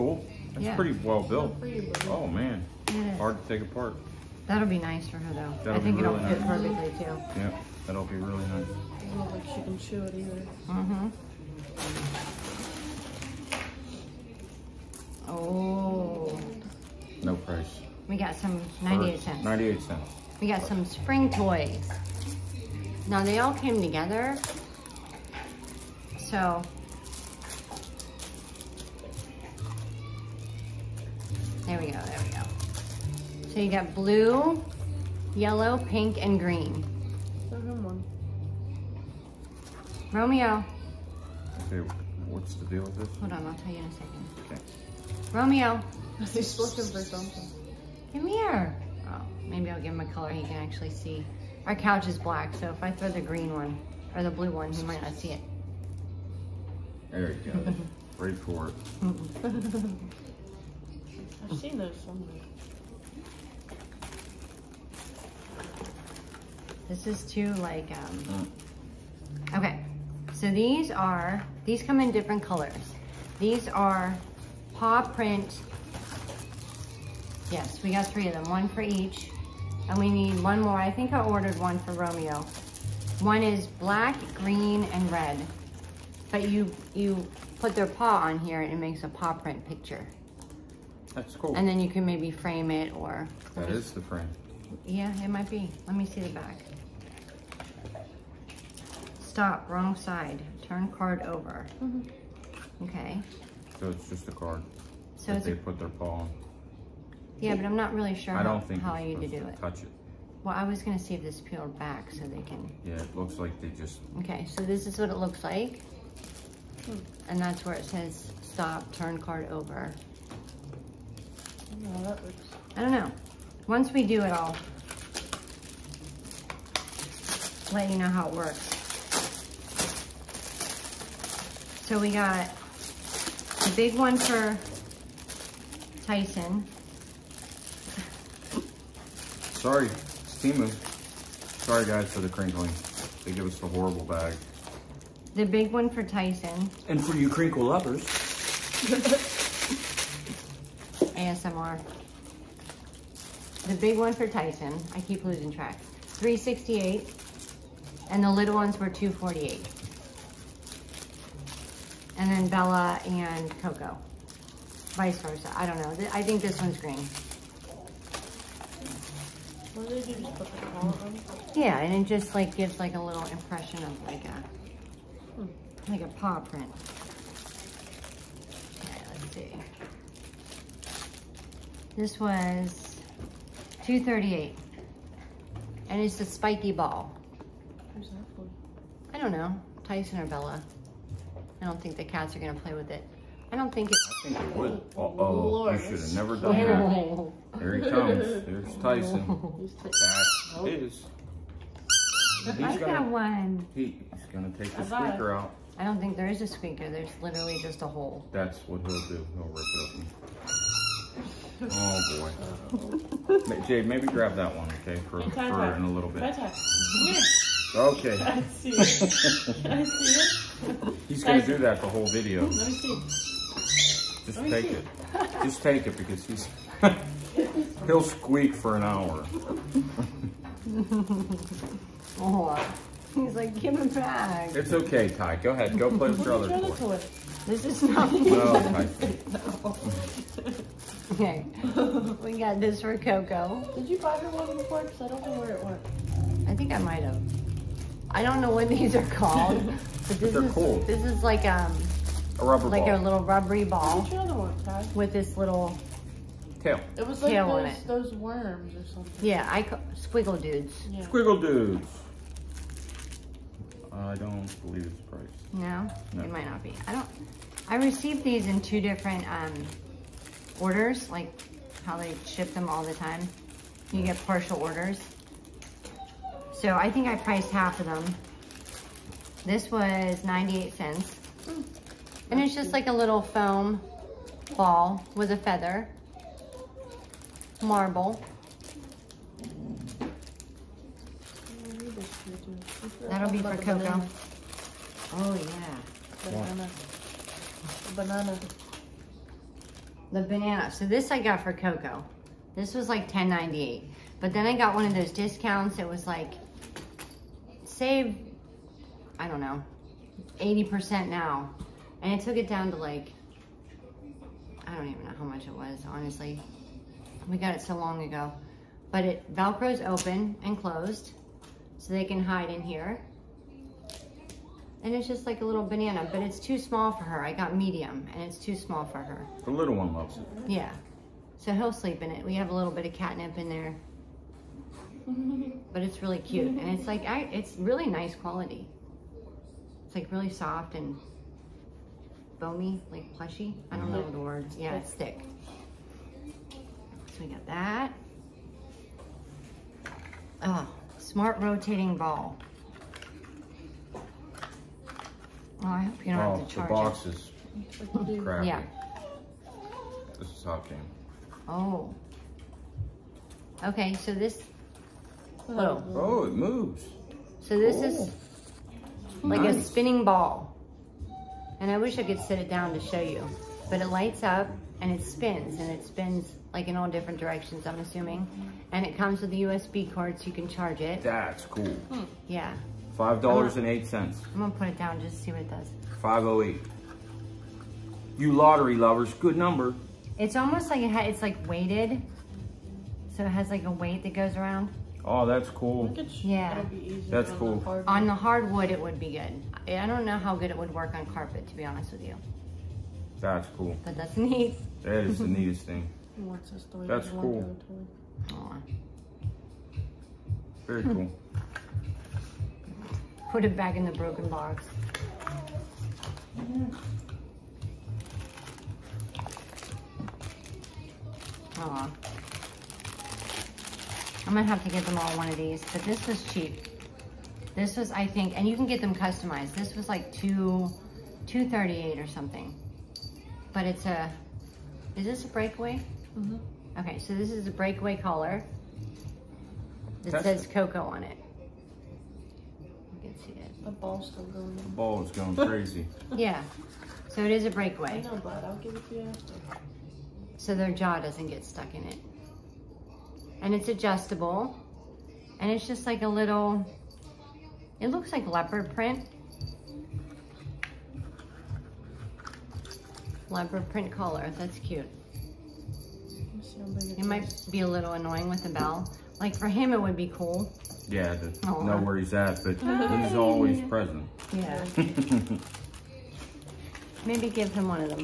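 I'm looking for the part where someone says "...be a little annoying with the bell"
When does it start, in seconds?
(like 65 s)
467 s.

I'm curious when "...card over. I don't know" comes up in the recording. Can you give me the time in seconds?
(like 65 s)
119 s.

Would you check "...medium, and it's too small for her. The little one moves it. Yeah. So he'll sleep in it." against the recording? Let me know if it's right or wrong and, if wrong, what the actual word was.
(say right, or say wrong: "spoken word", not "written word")
wrong: "loves", not "moves".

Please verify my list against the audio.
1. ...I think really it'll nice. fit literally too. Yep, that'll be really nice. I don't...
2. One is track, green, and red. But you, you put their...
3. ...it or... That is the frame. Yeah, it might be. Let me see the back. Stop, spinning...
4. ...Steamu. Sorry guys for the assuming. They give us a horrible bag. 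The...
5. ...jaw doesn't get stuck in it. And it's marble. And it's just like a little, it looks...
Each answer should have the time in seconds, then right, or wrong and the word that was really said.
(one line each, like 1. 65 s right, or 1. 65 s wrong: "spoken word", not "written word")
1. 5 s wrong: "perfectly", not "literally"
2. 83 s wrong: "black", not "track"
3. 92 s wrong: "wrong", not "spinning"
4. 140 s wrong: "crinkling", not "assuming"
5. 450 s wrong: "adjustable", not "marble".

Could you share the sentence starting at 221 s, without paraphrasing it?
He's gonna do that the whole video.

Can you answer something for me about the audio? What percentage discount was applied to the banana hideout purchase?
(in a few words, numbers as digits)
80%.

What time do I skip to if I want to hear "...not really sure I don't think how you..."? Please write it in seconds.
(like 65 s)
107 s.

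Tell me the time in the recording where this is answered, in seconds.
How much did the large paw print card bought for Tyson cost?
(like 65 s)
156 s.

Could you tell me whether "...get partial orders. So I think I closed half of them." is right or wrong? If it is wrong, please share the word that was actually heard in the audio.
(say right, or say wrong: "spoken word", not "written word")
wrong: "priced", not "closed".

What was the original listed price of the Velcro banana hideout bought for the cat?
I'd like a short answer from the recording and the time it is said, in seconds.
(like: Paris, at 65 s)
$10.98, at 303 s.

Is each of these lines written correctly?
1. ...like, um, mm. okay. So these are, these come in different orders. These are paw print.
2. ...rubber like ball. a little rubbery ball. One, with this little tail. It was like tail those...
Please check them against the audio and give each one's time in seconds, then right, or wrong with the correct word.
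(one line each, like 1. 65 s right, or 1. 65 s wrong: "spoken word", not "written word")
1. 67 s wrong: "colors", not "orders"
2. 252 s right.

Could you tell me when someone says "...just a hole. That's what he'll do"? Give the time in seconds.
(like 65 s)
207 s.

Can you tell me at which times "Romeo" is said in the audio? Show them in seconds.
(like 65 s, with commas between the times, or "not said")
40 s, 45 s, 81 s.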